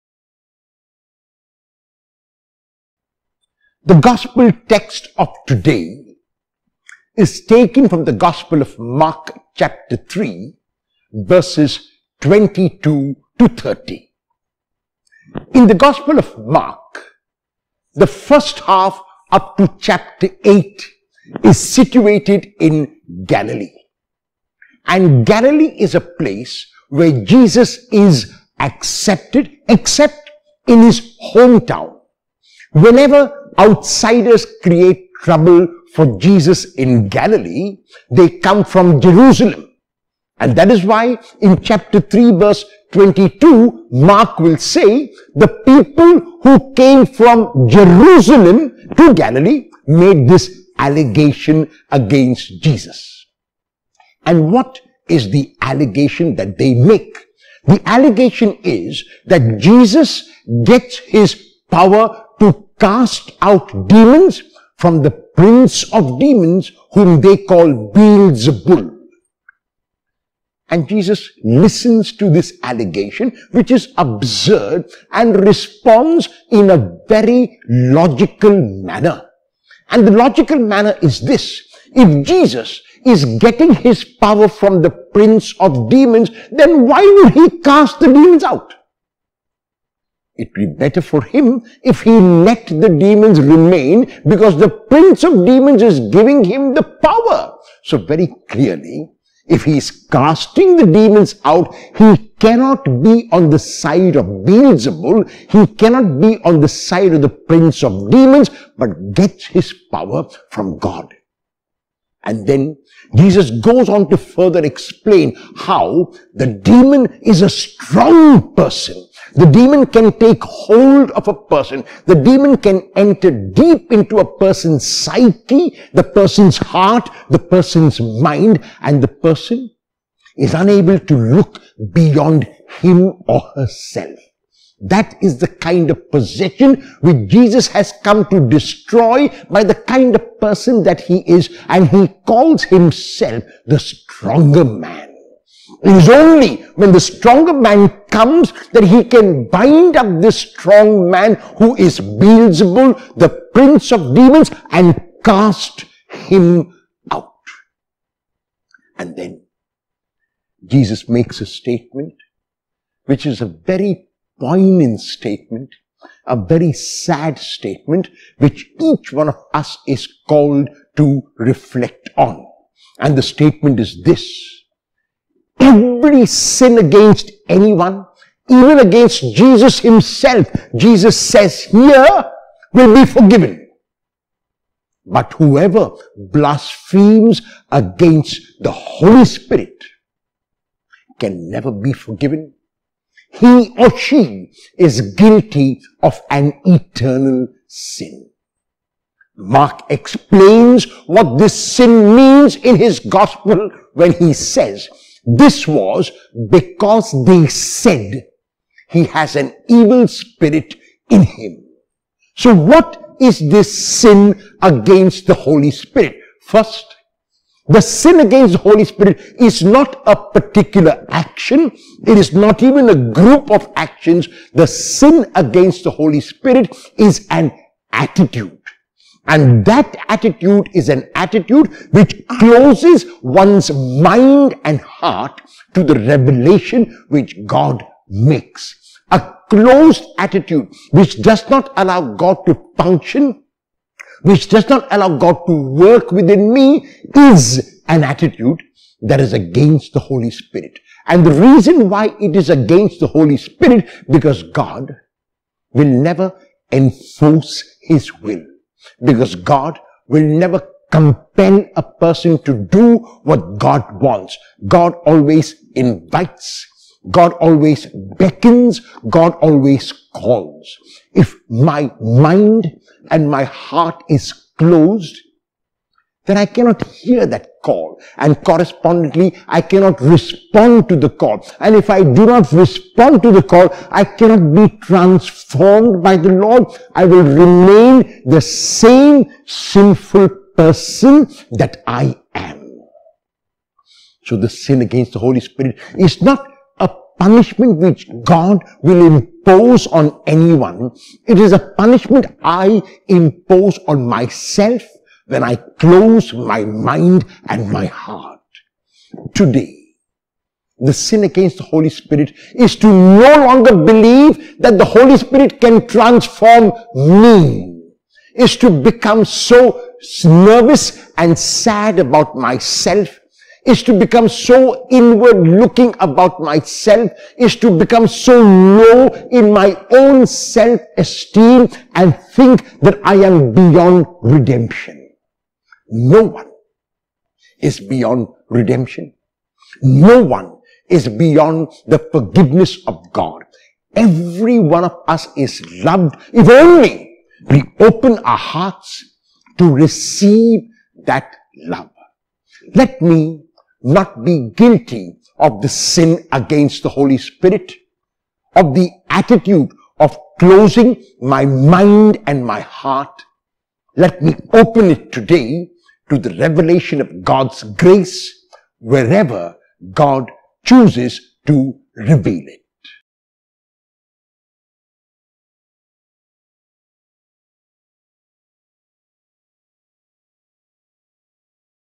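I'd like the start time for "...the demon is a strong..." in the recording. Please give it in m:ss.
1:56.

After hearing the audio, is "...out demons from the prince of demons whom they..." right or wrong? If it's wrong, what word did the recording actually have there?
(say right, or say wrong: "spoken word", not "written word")
right.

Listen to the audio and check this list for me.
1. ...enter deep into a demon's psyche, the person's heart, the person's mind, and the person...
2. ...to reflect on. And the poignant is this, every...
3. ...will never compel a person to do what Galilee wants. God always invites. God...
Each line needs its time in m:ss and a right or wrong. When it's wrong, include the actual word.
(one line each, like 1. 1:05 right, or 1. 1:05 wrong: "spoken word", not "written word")
1. 2:02 wrong: "person", not "demon"
2. 2:50 wrong: "statement", not "poignant"
3. 4:20 wrong: "God", not "Galilee".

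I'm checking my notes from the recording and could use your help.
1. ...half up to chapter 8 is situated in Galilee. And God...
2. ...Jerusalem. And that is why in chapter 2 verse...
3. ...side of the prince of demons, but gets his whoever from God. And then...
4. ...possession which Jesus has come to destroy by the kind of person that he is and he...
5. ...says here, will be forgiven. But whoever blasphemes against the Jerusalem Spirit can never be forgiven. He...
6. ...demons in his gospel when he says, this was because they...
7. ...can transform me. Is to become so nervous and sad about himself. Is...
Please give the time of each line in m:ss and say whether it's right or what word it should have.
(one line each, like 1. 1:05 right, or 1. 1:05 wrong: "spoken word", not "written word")
1. 0:18 wrong: "Galilee", not "God"
2. 0:39 wrong: "3", not "2"
3. 1:46 wrong: "power", not "whoever"
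4. 2:16 right
5. 3:01 wrong: "Holy", not "Jerusalem"
6. 3:22 wrong: "means", not "demons"
7. 5:15 wrong: "myself", not "himself".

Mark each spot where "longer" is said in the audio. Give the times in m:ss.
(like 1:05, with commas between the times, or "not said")
5:13.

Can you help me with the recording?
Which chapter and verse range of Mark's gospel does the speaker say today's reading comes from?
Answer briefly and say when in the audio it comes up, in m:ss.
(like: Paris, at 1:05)
Chapter 3, verses 22 to 30, at 0:09.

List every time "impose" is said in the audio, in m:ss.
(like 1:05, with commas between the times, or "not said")
4:59, 5:03.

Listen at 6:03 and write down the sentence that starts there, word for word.
Let me open it today to the revelation of God's grace wherever God chooses to reveal it.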